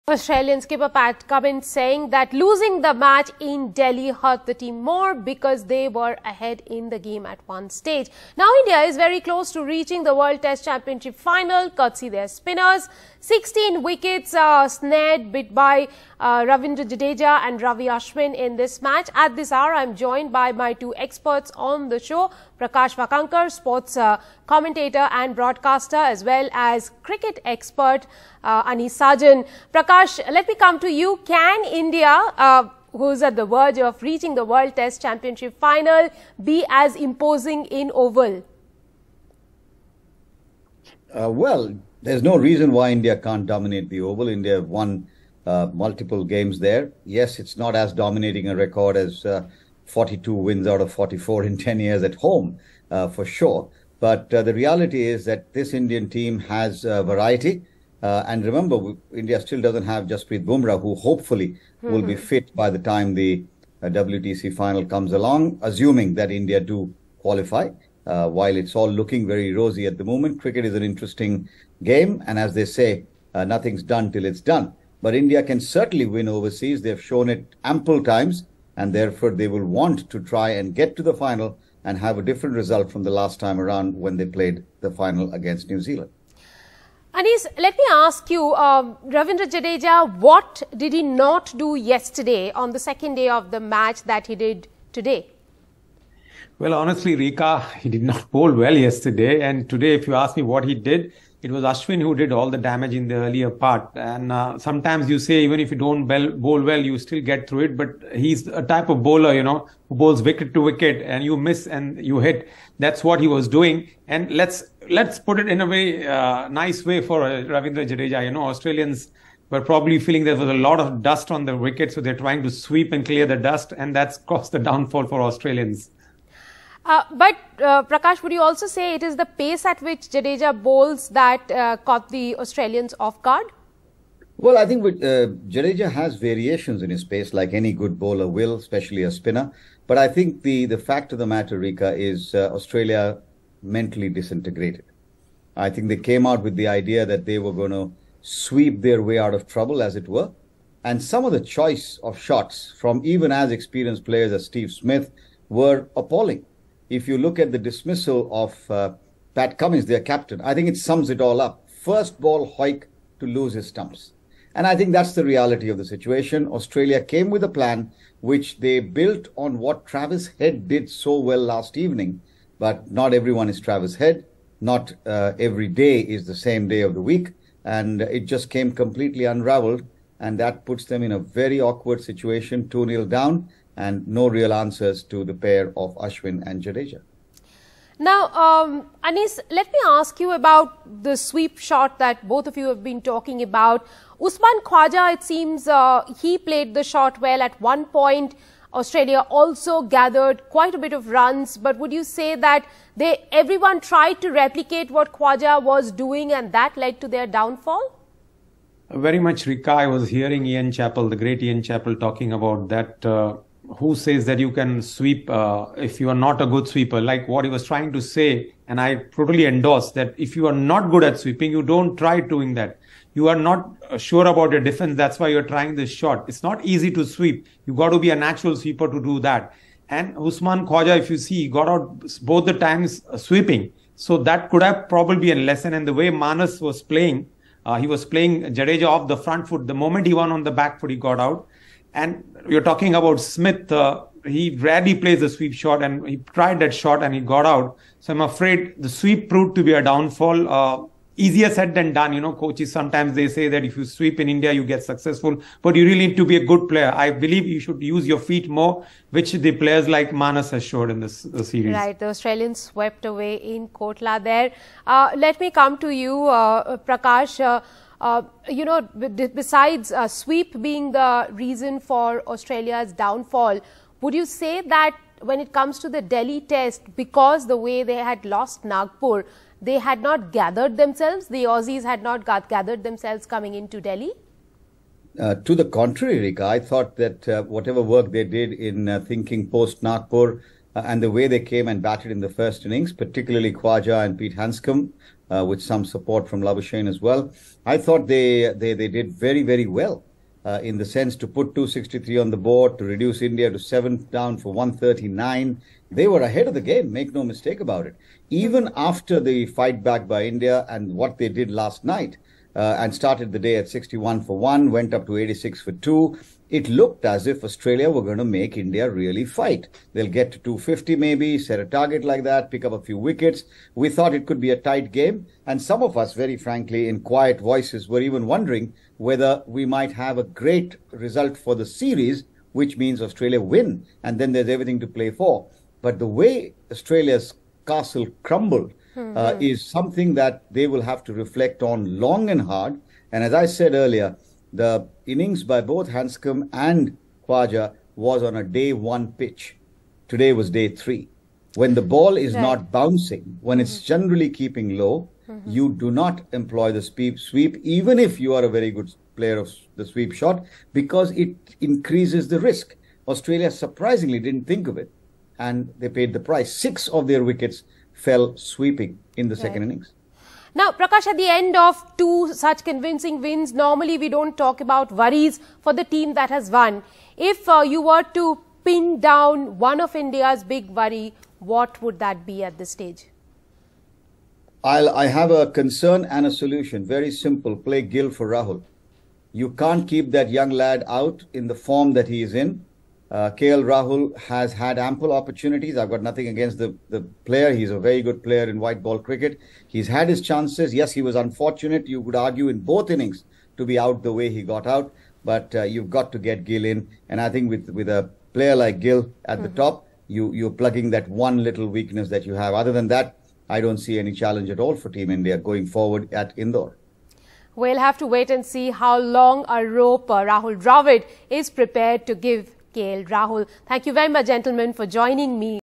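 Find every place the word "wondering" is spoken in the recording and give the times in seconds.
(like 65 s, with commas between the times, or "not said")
328 s.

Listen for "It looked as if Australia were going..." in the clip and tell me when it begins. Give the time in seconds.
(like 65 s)
316 s.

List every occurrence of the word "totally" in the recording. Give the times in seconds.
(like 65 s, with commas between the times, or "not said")
219 s.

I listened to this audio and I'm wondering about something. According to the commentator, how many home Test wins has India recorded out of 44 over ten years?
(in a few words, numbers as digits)
42.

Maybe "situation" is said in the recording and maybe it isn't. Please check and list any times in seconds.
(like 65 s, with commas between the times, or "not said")
165 s, 182 s.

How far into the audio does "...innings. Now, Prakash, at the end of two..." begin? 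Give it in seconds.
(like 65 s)
369 s.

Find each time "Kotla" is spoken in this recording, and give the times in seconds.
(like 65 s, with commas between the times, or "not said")
263 s.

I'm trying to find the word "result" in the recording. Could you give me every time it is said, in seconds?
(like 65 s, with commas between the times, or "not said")
82 s, 330 s.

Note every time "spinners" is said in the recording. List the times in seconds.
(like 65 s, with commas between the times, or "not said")
12 s, 139 s.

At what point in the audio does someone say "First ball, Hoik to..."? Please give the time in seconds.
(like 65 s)
161 s.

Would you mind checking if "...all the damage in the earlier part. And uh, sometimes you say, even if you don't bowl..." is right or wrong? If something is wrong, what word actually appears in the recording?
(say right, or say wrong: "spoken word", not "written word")
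right.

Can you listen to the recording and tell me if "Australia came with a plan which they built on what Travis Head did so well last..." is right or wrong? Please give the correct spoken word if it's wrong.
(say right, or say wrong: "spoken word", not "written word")
right.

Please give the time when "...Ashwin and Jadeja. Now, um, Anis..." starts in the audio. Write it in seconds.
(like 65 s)
185 s.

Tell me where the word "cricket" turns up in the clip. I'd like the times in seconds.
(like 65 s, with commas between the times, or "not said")
27 s, 70 s, 398 s.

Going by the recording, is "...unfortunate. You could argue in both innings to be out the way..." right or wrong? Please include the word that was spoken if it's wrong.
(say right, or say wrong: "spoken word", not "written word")
right.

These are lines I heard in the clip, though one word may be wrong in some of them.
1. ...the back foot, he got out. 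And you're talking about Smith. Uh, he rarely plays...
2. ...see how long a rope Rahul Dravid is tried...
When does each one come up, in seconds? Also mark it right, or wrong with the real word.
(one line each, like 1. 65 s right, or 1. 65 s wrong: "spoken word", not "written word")
1. 240 s right
2. 418 s wrong: "prepared", not "tried".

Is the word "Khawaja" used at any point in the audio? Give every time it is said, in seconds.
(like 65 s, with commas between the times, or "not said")
194 s, 205 s, 230 s, 293 s, 347 s.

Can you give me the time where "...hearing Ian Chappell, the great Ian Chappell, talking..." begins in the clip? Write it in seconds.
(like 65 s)
210 s.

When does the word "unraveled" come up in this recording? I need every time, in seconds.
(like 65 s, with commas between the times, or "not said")
179 s.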